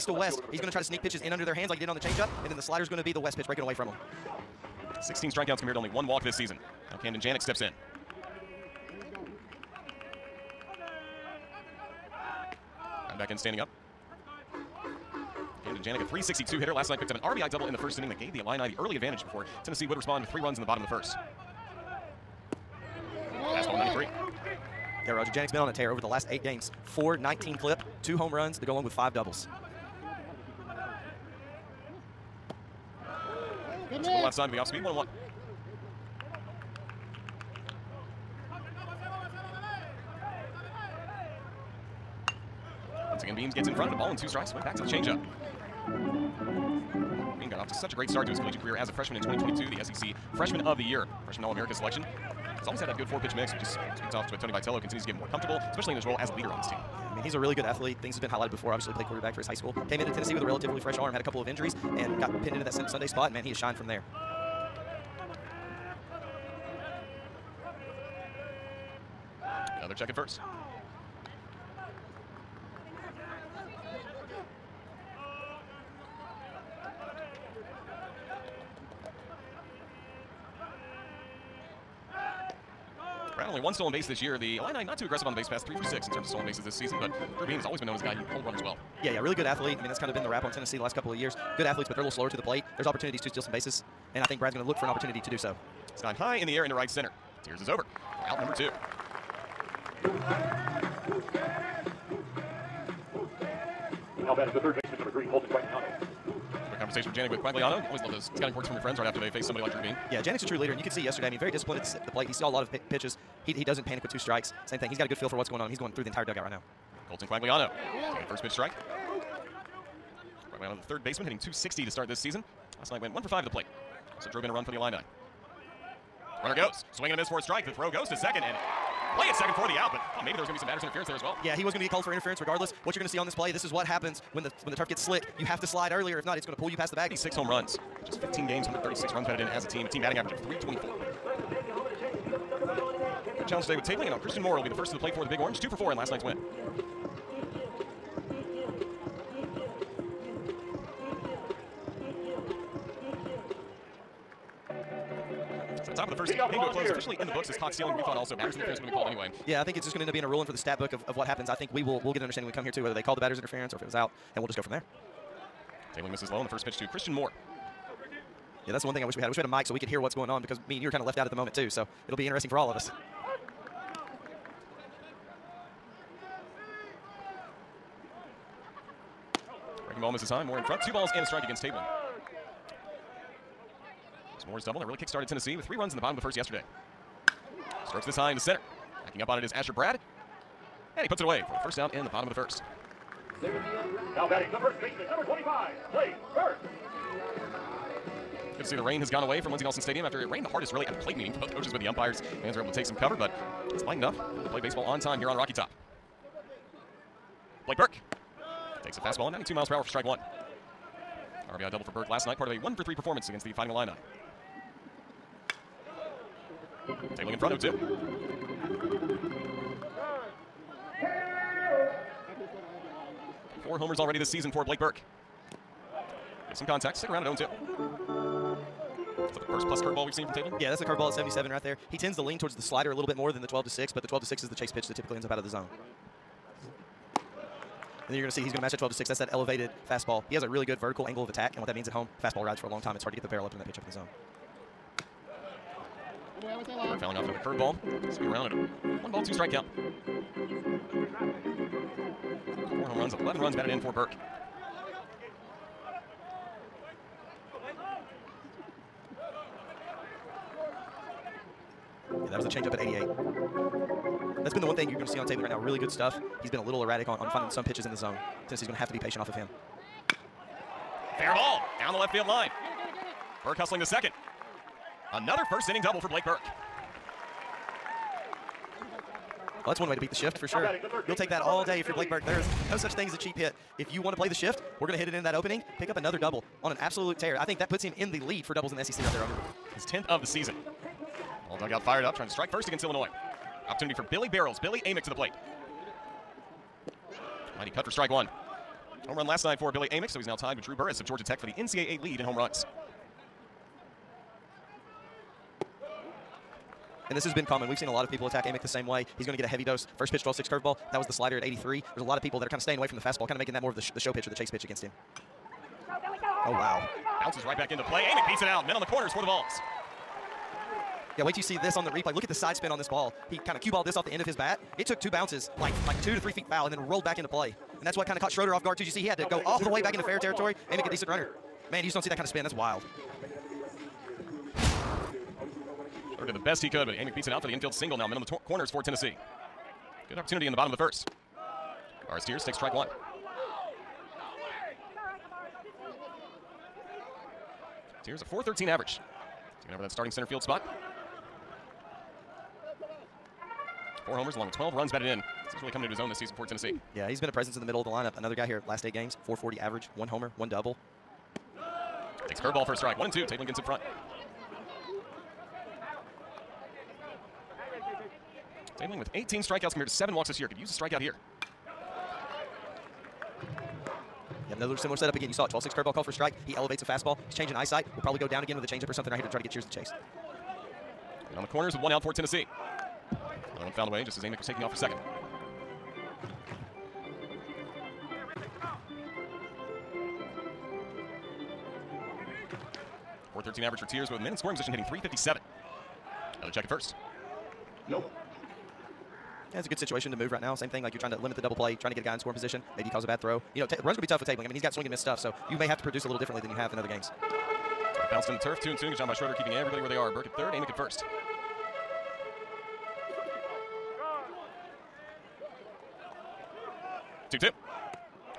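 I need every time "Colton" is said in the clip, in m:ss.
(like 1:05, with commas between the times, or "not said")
1:45, 1:57.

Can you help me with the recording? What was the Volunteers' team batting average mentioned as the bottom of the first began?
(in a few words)
.324.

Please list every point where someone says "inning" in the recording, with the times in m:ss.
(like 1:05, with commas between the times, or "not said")
0:17, 4:35.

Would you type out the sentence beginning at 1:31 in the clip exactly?
Good athletes, but they're a little slower to the plate.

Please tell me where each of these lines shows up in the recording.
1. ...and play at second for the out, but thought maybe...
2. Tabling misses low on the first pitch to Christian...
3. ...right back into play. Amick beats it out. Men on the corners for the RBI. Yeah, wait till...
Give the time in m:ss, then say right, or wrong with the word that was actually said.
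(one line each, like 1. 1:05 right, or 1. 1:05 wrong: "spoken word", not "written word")
1. 2:08 right
2. 2:45 right
3. 5:17 wrong: "Vols", not "RBI".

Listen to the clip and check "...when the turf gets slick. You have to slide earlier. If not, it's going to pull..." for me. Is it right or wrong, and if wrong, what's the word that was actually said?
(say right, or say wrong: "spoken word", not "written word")
right.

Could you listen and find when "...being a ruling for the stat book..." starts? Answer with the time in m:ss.
2:40.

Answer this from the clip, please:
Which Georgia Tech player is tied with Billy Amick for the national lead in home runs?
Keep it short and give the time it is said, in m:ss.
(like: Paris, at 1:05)
Drew Burress, at 5:00.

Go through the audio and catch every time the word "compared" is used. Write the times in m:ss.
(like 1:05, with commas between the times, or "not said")
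0:05, 6:09.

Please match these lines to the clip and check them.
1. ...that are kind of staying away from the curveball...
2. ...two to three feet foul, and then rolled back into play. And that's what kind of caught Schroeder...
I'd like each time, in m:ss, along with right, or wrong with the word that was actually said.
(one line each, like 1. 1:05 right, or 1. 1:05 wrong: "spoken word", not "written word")
1. 5:12 wrong: "fastball", not "curveball"
2. 5:26 right.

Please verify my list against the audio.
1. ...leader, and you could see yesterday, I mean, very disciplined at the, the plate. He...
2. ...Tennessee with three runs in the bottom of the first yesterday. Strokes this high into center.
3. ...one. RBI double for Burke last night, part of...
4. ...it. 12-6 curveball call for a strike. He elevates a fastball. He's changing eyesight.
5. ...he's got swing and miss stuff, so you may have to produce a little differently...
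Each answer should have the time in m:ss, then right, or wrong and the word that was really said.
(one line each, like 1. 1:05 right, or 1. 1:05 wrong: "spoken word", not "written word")
1. 1:50 right
2. 3:05 right
3. 3:30 right
4. 6:15 right
5. 6:44 right.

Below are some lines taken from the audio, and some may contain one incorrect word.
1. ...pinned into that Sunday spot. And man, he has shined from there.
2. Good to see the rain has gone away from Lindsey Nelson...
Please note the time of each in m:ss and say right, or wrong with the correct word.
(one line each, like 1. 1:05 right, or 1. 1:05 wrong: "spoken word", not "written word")
1. 1:02 right
2. 3:18 right.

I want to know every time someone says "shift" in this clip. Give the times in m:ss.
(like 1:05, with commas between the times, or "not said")
4:40, 4:44.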